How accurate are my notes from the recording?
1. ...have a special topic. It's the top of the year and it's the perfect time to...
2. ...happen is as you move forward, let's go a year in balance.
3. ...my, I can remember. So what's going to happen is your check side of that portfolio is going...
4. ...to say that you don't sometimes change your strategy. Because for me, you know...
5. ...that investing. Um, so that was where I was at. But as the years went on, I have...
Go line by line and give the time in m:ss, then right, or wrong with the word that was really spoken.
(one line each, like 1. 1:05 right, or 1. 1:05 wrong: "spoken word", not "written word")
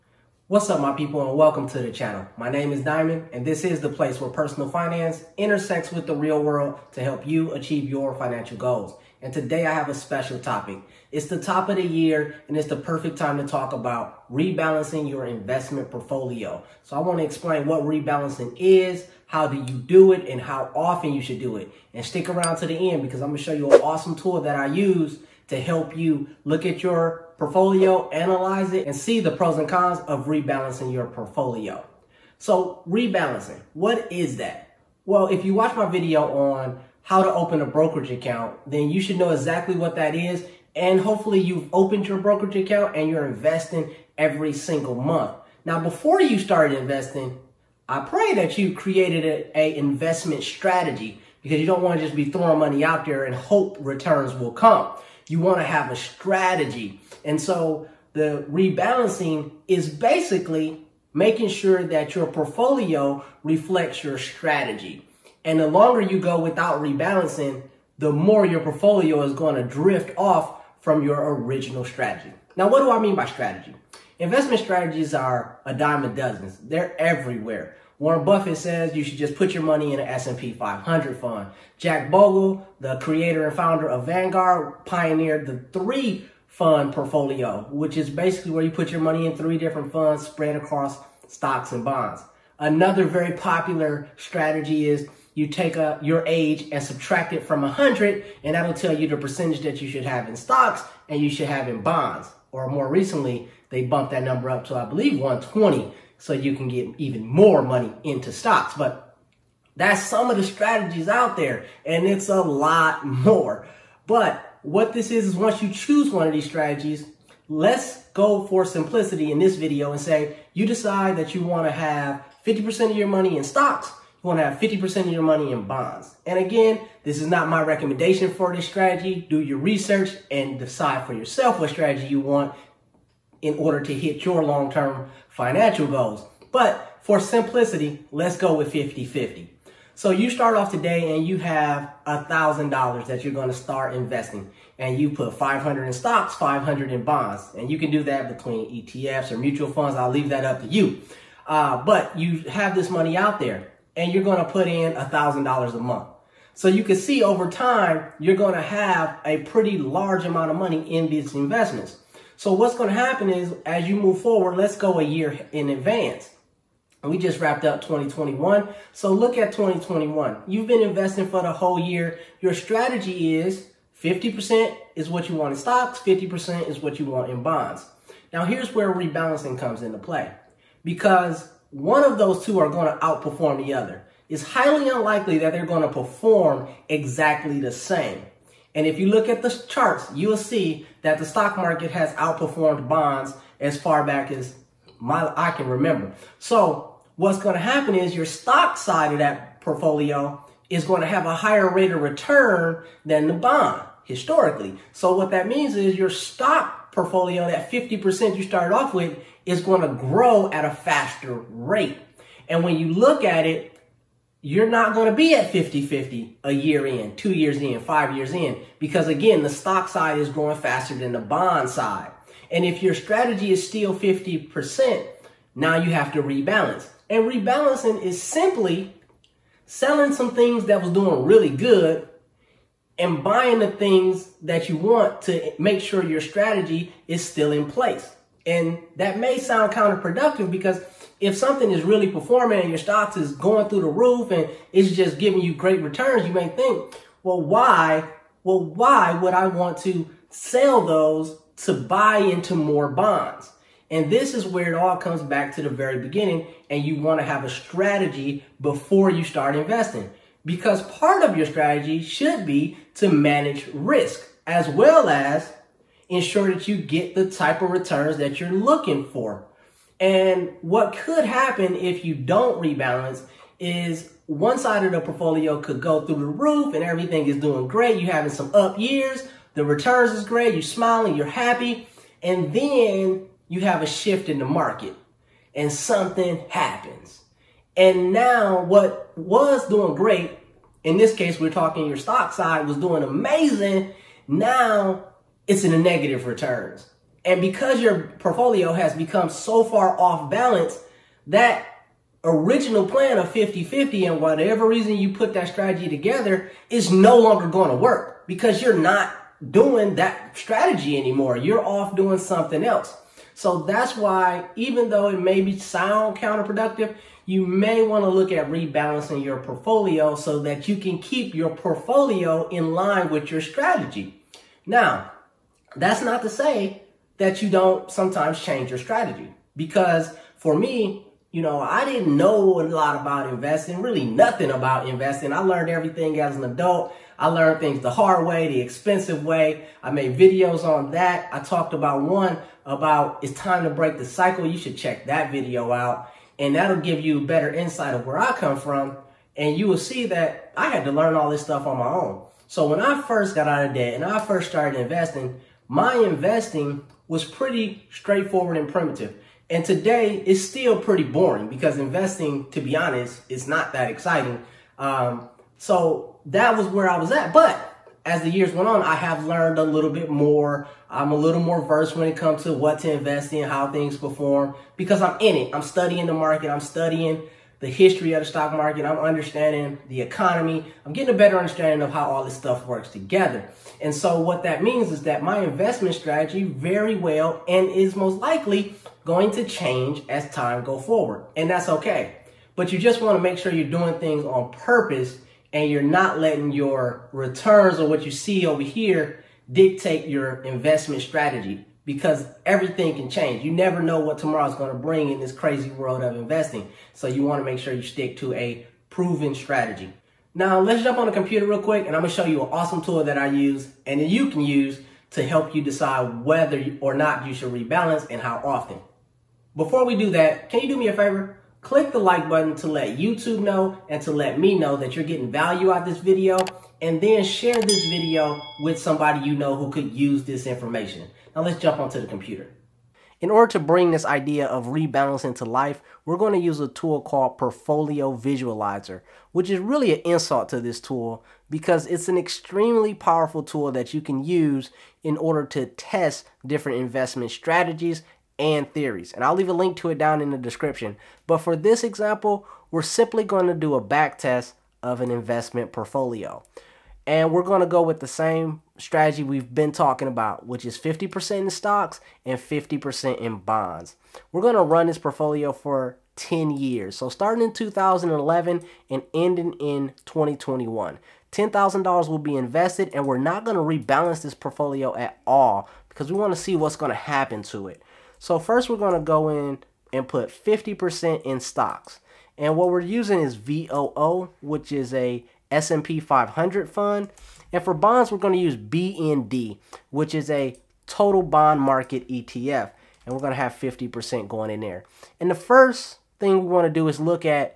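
1. 0:09 right
2. 2:42 wrong: "advance", not "balance"
3. 3:14 wrong: "stock", not "check"
4. 5:26 right
5. 6:03 wrong: "exciting", not "investing".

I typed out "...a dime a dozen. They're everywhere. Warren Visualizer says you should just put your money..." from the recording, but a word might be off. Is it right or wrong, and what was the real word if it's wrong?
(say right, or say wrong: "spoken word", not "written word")
wrong: "Buffett", not "Visualizer".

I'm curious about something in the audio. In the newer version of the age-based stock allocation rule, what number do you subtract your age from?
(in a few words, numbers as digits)
120.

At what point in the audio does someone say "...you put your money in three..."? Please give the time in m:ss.
1:28.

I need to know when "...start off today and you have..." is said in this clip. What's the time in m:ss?
2:20.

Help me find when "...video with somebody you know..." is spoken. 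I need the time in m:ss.
7:07.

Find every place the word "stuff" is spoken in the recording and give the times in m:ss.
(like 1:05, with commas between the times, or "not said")
5:51, 6:22.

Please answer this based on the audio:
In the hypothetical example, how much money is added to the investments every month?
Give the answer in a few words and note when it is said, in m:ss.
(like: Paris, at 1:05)
$1,000, at 2:34.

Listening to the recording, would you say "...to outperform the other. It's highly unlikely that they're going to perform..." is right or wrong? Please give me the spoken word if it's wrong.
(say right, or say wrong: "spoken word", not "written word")
right.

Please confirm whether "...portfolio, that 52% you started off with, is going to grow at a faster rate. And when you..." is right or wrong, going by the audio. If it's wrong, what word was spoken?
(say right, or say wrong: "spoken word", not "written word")
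wrong: "50", not "52".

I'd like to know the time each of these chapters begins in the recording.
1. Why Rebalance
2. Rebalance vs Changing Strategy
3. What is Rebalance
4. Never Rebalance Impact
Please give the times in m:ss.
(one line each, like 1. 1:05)
1. 2:47
2. 5:24
3. 0:32
4. 7:11.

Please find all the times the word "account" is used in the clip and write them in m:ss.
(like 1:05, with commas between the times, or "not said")
0:38, 0:42.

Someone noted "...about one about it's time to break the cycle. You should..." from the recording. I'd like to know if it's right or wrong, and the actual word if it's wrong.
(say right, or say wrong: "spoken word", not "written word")
right.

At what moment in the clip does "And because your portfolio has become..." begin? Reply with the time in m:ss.
4:57.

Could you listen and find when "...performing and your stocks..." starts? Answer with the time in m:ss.
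4:02.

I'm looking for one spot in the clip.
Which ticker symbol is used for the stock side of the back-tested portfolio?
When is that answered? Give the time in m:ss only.
8:03.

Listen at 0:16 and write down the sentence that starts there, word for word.
So I want to explain what rebalancing is, how do you do it and how often you should do it.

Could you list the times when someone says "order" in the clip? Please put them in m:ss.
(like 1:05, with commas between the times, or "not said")
2:13, 7:13, 7:25.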